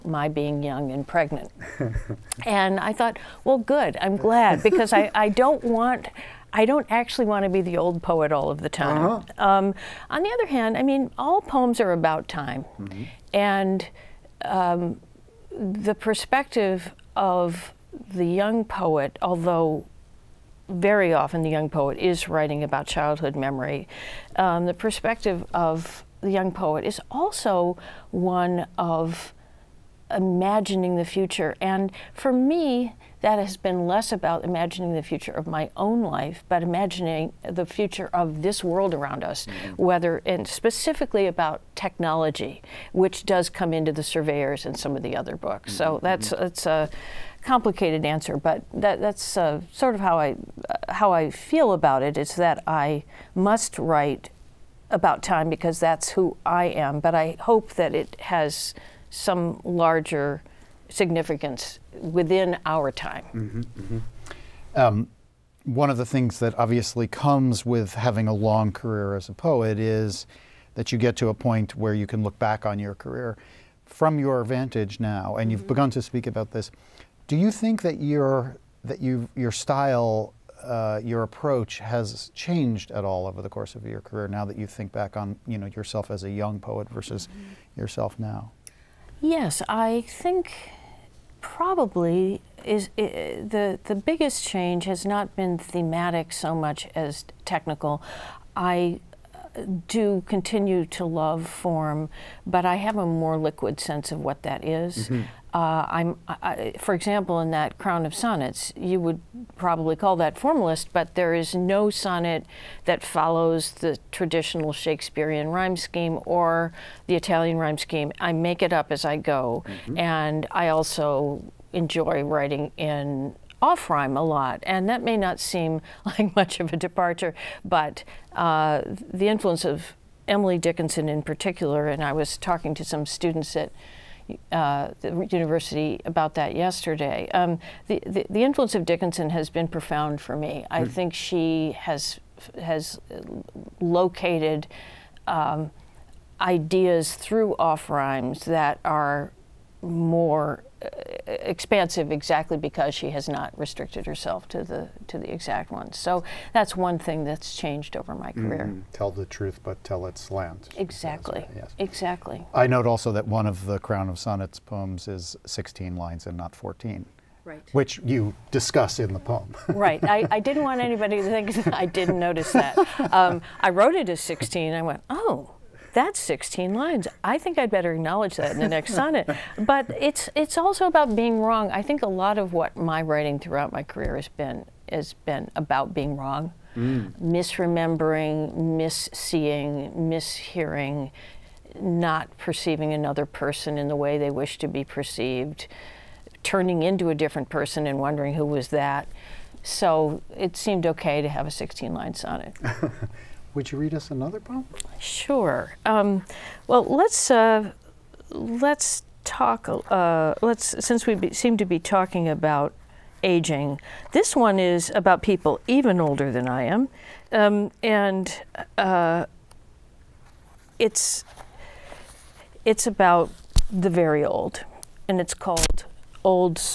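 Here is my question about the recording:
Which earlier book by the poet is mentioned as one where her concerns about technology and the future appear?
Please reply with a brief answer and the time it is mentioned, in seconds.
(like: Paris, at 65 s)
The Surveyors, at 44 s.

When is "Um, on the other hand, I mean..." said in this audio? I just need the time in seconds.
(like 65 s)
9 s.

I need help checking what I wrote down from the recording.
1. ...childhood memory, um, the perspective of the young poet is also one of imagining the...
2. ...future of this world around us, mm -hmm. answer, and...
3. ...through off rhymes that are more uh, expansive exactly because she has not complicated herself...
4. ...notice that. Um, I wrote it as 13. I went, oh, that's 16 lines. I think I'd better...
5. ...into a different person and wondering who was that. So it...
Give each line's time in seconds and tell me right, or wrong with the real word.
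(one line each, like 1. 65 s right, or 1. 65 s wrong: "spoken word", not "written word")
1. 22 s right
2. 37 s wrong: "whether", not "answer"
3. 147 s wrong: "restricted", not "complicated"
4. 172 s wrong: "16", not "13"
5. 196 s right.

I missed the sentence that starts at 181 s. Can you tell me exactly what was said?
I think a lot of what my writing throughout my career has been, has been about being wrong, mm.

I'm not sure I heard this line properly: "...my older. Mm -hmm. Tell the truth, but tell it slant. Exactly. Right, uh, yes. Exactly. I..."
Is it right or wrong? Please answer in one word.
wrong.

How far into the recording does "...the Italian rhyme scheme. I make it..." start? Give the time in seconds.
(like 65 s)
117 s.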